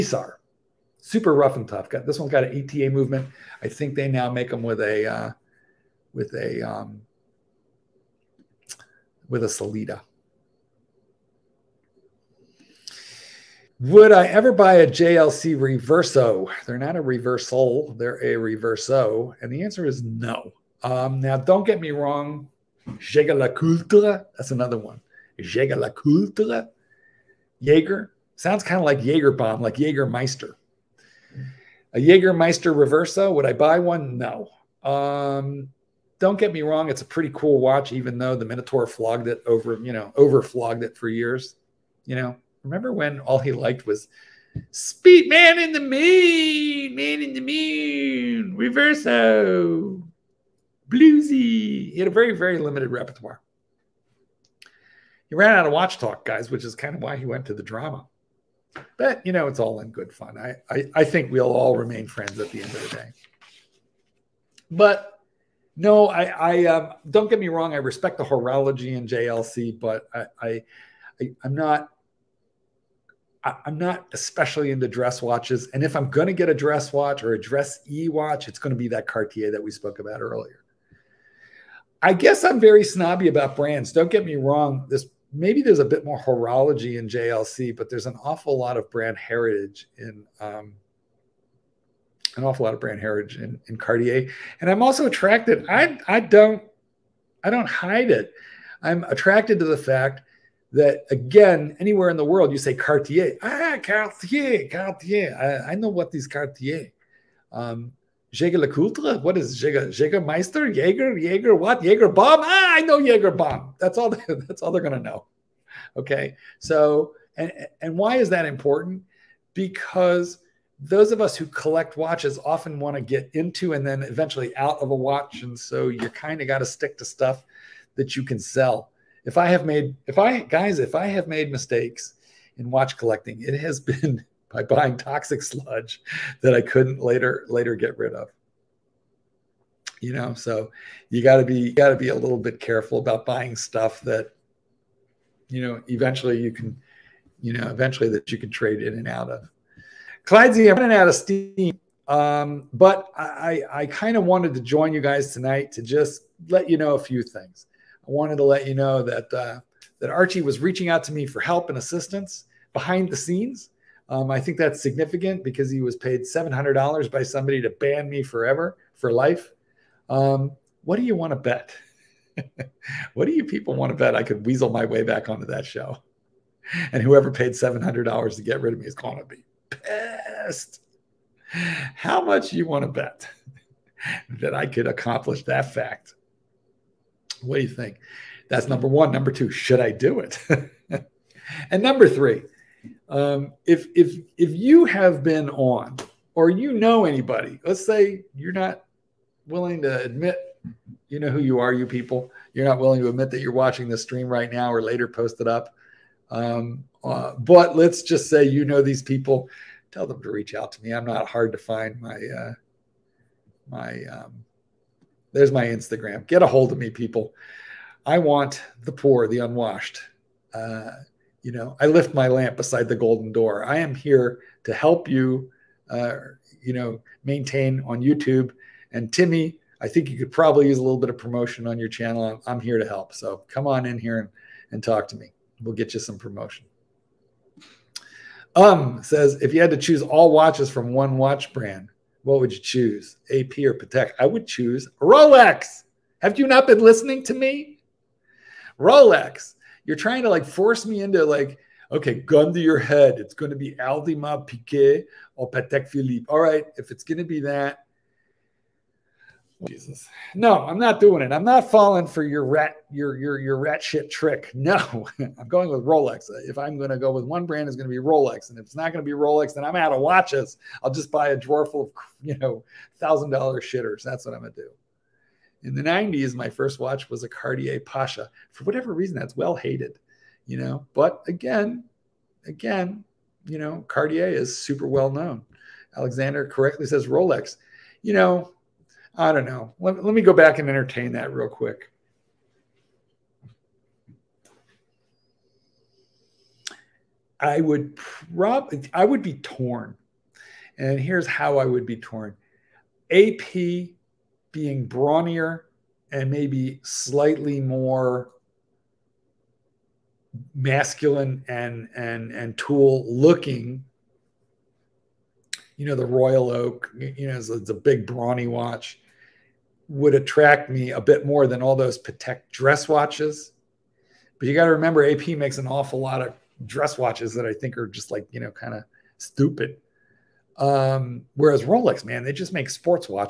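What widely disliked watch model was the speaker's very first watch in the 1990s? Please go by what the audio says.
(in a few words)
Cartier Pasha.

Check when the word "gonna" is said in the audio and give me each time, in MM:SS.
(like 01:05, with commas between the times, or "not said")
01:54.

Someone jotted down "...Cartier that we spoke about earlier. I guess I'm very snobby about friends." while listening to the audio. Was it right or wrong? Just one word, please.
wrong.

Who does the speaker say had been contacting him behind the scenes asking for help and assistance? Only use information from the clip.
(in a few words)
Archie.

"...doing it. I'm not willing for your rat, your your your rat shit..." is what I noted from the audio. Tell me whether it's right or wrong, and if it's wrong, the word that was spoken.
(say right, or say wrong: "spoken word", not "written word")
wrong: "falling", not "willing".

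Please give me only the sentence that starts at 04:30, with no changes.
I'll just buy a drawer full of you know thousand dollar shitters.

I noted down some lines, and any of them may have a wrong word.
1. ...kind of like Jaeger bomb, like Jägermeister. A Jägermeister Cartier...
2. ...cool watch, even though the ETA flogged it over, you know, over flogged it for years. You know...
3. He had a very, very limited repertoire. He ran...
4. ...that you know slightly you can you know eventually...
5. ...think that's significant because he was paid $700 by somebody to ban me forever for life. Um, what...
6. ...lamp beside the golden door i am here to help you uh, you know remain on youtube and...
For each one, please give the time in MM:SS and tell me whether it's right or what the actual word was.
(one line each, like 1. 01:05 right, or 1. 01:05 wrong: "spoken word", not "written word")
1. 00:28 wrong: "Reversa", not "Cartier"
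2. 00:37 wrong: "Minotaur", not "ETA"
3. 00:51 right
4. 02:24 wrong: "eventually", not "slightly"
5. 02:44 right
6. 03:42 wrong: "maintain", not "remain".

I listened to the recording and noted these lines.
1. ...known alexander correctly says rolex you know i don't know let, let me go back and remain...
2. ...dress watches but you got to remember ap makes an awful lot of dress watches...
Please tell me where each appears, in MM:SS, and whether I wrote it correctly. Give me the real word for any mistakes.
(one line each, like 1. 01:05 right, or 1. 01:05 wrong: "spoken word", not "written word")
1. 04:45 wrong: "entertain", not "remain"
2. 05:22 right.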